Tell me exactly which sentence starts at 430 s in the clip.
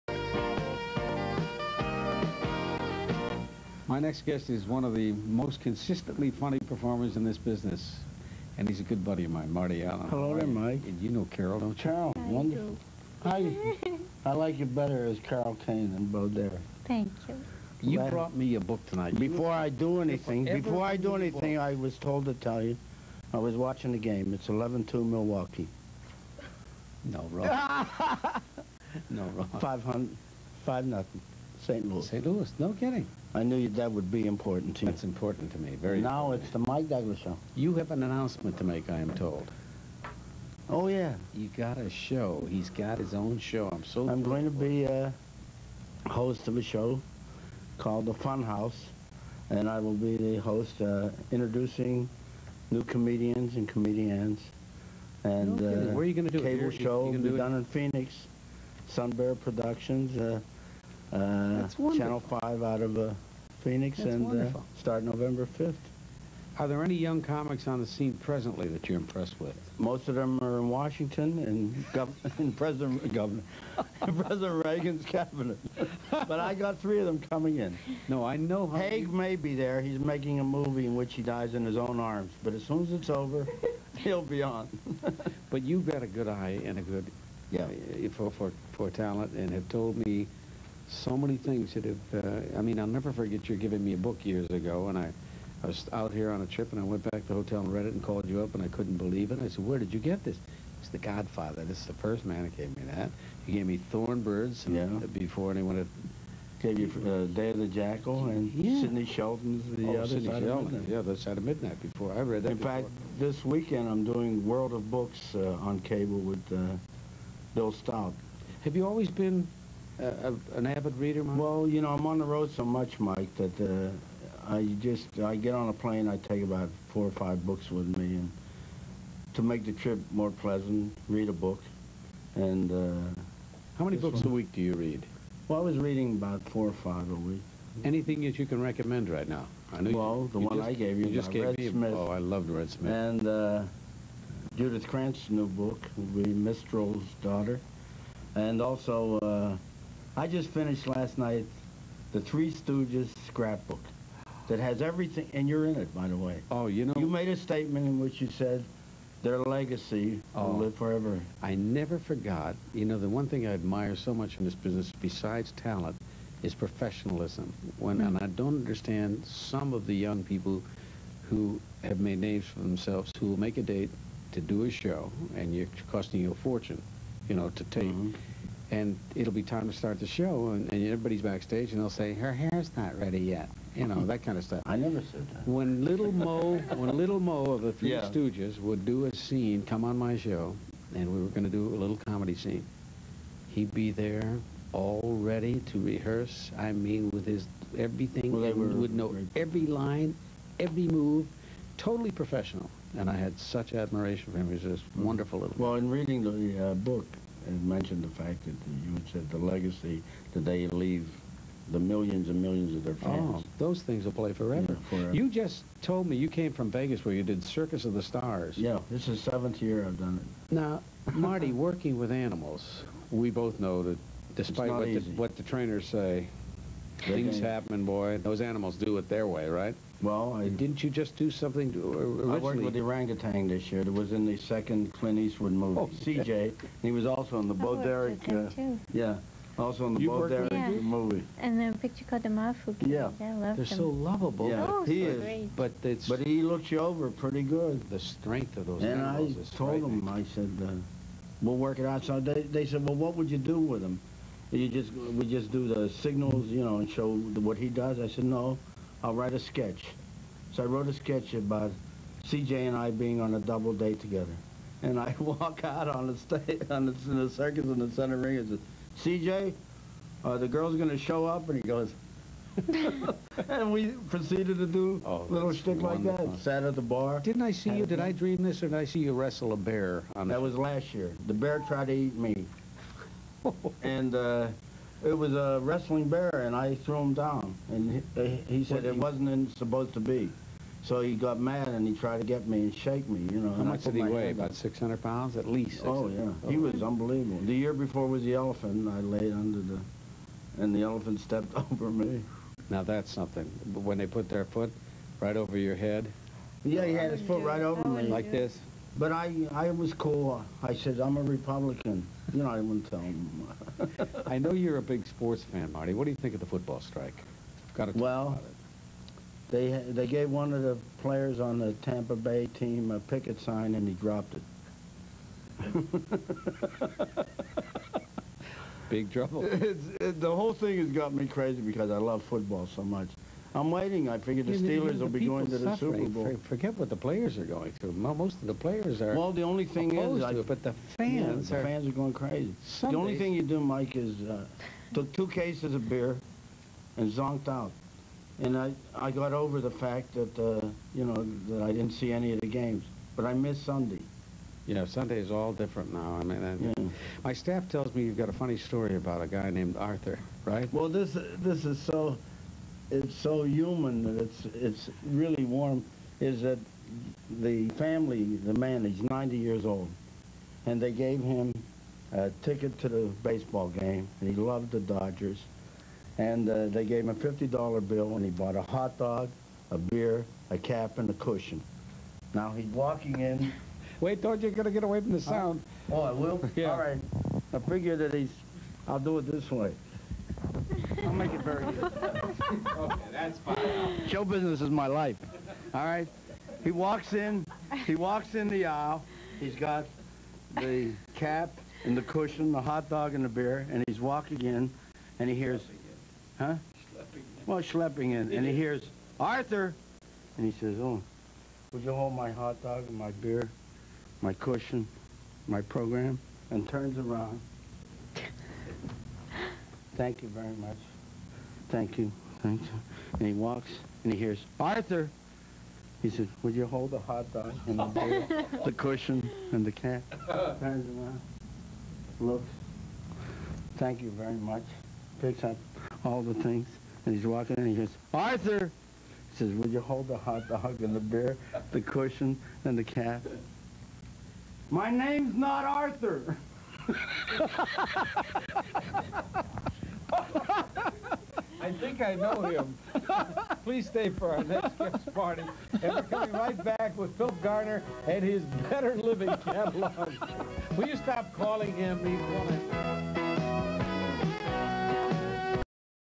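Turns around, looks, thank you very much, picks up all the things, and he's walking in and he goes, Arthur!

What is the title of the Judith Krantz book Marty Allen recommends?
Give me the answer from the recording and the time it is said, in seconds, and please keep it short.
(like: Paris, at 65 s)
Mistral's Daughter, at 146 s.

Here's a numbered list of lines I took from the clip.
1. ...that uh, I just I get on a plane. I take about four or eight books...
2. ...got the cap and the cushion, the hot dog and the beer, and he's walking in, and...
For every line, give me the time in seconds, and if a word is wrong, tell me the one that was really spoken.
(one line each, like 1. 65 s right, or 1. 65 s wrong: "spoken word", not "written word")
1. 123 s wrong: "five", not "eight"
2. 399 s right.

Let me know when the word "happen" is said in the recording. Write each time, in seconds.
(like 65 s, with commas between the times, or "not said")
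227 s.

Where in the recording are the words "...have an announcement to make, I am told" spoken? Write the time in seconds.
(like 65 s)
37 s.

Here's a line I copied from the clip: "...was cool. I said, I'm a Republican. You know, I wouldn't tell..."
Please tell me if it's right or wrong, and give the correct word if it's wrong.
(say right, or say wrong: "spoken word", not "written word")
right.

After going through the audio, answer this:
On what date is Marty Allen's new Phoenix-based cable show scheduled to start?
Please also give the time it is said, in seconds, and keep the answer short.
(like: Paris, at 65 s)
November 5th, at 65 s.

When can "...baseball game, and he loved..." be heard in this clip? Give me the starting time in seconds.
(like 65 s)
373 s.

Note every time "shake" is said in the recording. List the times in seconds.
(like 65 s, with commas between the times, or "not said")
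292 s.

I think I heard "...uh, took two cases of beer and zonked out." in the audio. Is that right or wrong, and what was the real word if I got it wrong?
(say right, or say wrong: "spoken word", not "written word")
right.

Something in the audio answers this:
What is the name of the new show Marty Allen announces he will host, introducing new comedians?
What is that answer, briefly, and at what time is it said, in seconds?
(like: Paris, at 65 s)
The Fun House, at 48 s.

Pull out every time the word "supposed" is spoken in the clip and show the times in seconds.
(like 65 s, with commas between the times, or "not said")
289 s.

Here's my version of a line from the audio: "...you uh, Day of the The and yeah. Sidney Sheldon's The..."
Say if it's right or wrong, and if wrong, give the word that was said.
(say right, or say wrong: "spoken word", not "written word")
wrong: "Jackal", not "The".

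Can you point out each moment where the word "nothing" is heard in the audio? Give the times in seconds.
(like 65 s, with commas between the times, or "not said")
30 s.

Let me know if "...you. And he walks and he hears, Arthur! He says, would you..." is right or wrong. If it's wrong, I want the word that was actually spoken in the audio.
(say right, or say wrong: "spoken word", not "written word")
right.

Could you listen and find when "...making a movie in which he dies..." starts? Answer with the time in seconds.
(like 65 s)
79 s.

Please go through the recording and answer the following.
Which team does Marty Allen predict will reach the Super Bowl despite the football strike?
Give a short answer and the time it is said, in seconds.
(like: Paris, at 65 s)
Steelers, at 334 s.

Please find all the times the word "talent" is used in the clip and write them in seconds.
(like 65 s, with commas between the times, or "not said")
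88 s, 165 s.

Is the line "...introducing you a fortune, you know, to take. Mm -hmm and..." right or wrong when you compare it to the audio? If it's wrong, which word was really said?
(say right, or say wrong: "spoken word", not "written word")
wrong: "costing", not "introducing".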